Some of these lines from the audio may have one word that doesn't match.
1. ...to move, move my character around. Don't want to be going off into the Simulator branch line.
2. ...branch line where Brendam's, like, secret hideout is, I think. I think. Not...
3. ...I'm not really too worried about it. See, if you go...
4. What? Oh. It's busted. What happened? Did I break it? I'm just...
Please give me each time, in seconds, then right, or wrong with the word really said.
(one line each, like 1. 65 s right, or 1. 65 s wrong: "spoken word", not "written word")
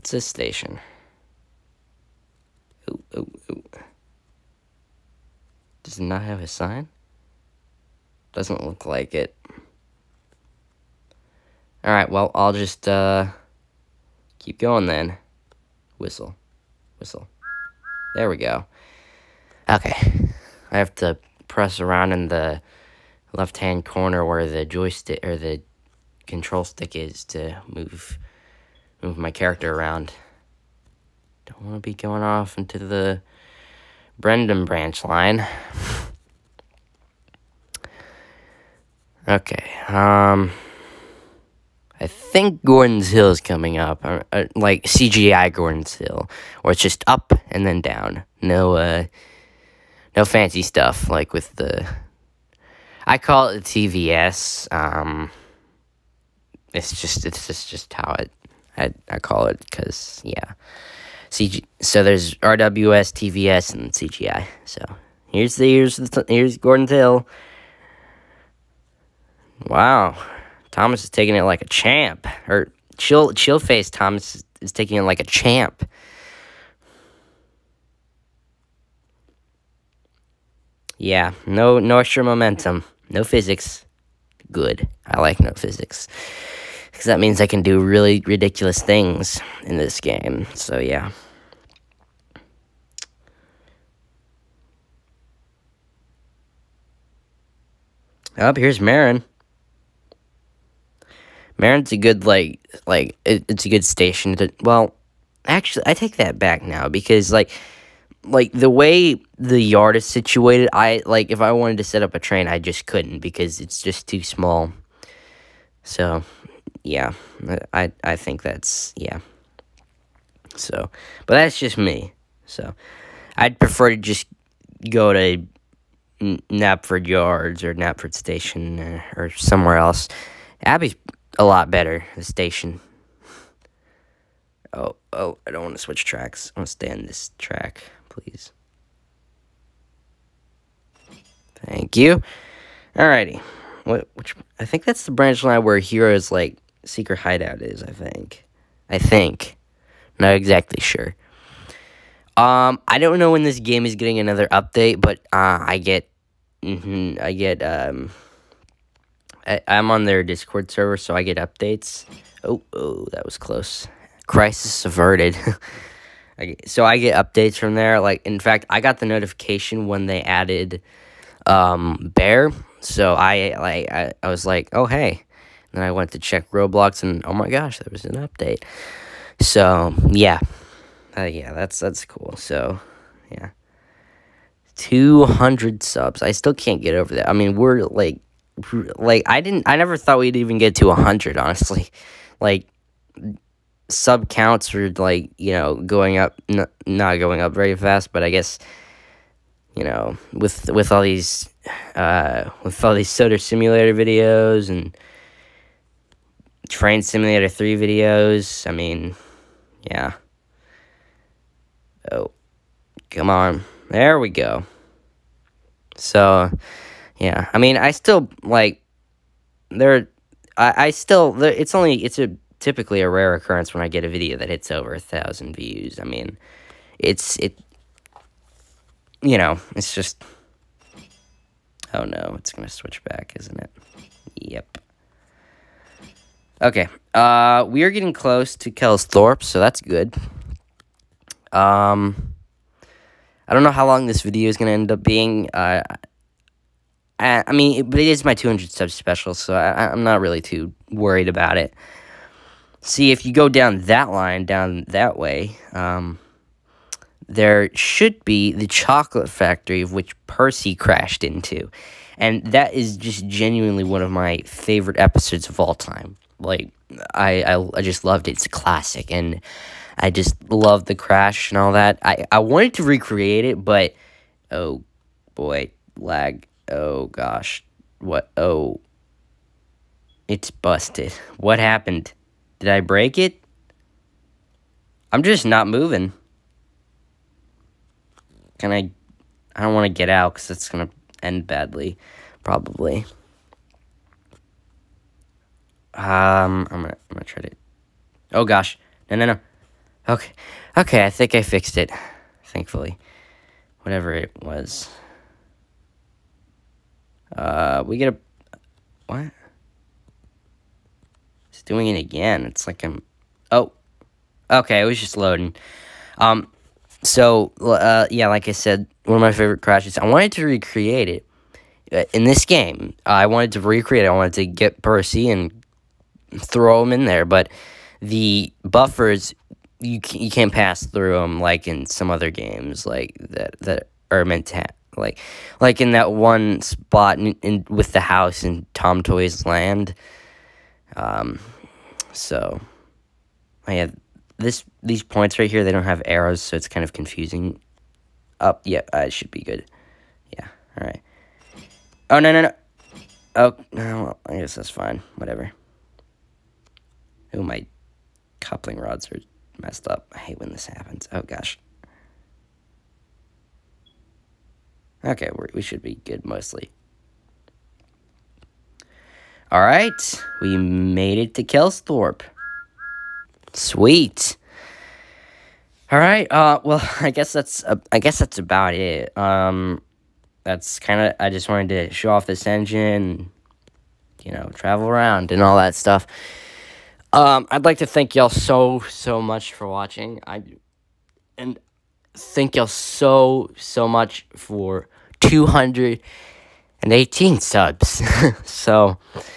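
1. 27 s wrong: "Brendam", not "Simulator"
2. 145 s wrong: "Hero", not "Brendam"
3. 249 s right
4. 277 s right.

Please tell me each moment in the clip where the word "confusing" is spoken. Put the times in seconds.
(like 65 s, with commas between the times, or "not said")
346 s.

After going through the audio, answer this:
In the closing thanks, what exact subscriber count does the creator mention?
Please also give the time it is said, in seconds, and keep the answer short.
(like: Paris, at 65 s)
218, at 395 s.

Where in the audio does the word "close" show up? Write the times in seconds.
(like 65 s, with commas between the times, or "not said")
163 s, 238 s.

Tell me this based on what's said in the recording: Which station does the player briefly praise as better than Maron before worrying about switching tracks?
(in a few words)
Abby.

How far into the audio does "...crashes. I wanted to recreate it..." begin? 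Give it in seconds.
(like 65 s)
319 s.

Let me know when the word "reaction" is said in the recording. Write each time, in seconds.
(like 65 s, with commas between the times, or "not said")
not said.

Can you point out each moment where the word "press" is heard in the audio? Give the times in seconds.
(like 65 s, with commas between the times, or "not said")
21 s.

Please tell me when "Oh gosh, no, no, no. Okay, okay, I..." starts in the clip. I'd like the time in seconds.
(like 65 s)
298 s.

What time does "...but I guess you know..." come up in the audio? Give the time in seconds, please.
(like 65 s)
198 s.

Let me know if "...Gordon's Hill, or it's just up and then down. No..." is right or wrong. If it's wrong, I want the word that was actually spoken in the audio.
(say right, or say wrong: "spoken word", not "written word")
right.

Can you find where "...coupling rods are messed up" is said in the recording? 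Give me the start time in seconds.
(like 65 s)
358 s.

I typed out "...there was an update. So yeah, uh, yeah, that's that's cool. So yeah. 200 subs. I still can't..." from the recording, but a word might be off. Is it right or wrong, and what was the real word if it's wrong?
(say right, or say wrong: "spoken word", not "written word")
right.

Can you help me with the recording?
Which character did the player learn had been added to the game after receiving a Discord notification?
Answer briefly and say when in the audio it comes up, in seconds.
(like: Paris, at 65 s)
Bear, at 172 s.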